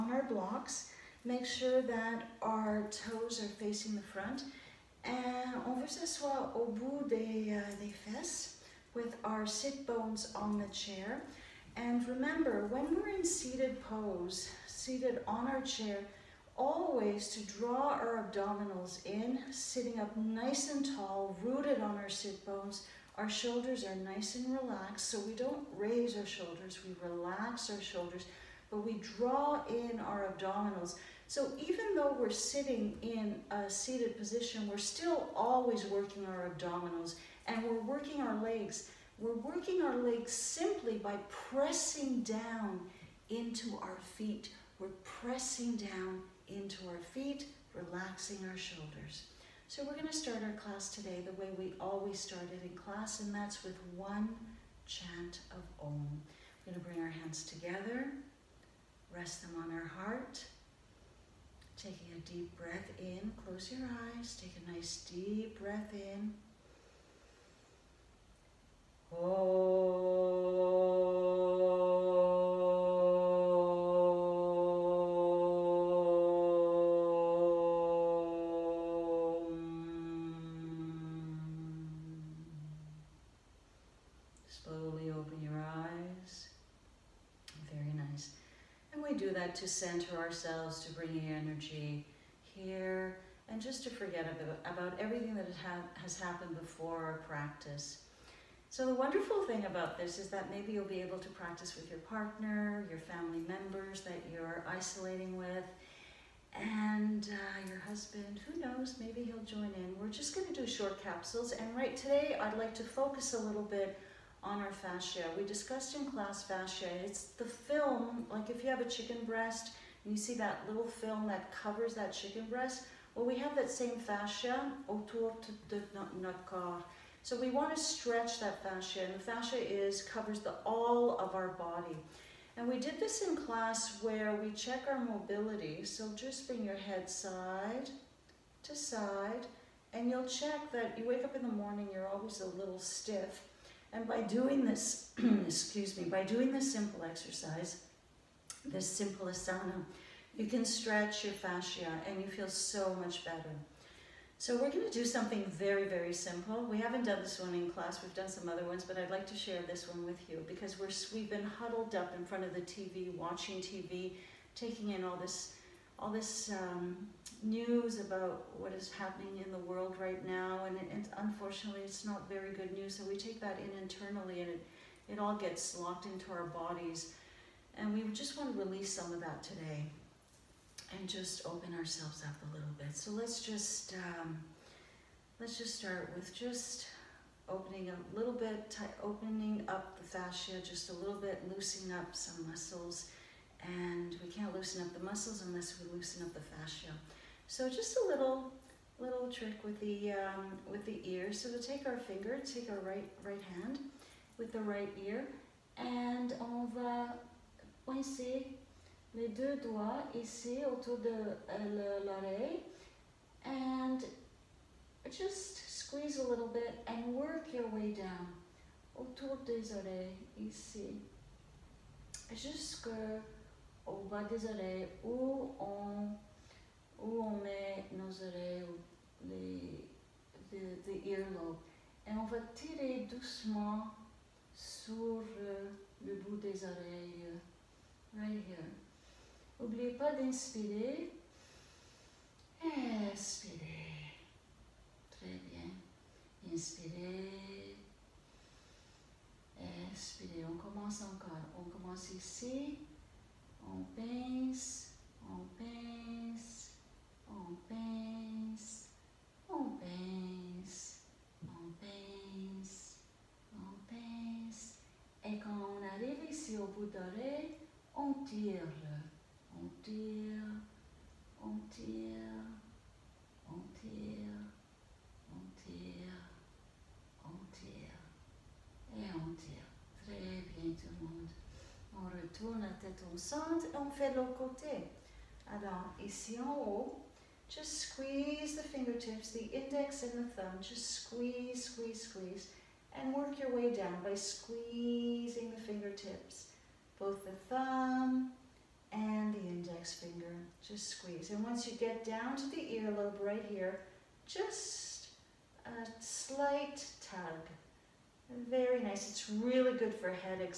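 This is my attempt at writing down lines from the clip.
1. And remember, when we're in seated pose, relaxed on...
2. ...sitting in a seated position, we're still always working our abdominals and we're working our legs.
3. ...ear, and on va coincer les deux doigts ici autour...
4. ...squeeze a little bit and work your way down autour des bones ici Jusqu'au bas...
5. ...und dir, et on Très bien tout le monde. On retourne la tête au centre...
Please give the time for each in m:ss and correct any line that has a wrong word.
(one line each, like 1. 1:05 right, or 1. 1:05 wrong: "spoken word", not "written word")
1. 0:11 wrong: "seated", not "relaxed"
2. 0:32 right
3. 3:25 right
4. 3:35 wrong: "oreilles", not "bones"
5. 4:33 right.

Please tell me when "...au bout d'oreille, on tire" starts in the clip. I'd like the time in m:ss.
4:26.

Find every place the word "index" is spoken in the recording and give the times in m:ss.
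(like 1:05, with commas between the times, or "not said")
4:49, 4:59.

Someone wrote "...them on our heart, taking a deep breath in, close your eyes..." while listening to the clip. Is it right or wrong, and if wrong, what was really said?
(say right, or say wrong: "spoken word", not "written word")
right.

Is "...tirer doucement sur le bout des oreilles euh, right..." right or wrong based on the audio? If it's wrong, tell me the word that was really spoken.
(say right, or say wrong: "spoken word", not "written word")
right.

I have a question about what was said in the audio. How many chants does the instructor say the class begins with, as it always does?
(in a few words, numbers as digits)
1.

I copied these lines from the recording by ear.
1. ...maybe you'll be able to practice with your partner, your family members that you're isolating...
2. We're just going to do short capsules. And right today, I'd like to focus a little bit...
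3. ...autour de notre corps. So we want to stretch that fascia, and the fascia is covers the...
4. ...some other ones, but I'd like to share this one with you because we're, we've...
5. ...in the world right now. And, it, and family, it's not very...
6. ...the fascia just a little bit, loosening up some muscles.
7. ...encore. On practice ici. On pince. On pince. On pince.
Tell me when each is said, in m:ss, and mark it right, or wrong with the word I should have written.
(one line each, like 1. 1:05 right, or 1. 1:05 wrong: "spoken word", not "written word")
1. 1:40 right
2. 1:49 right
3. 2:04 right
4. 2:38 right
5. 2:49 wrong: "unfortunately", not "family"
6. 3:09 right
7. 4:11 wrong: "commence", not "practice".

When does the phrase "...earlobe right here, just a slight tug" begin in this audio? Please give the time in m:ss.
5:02.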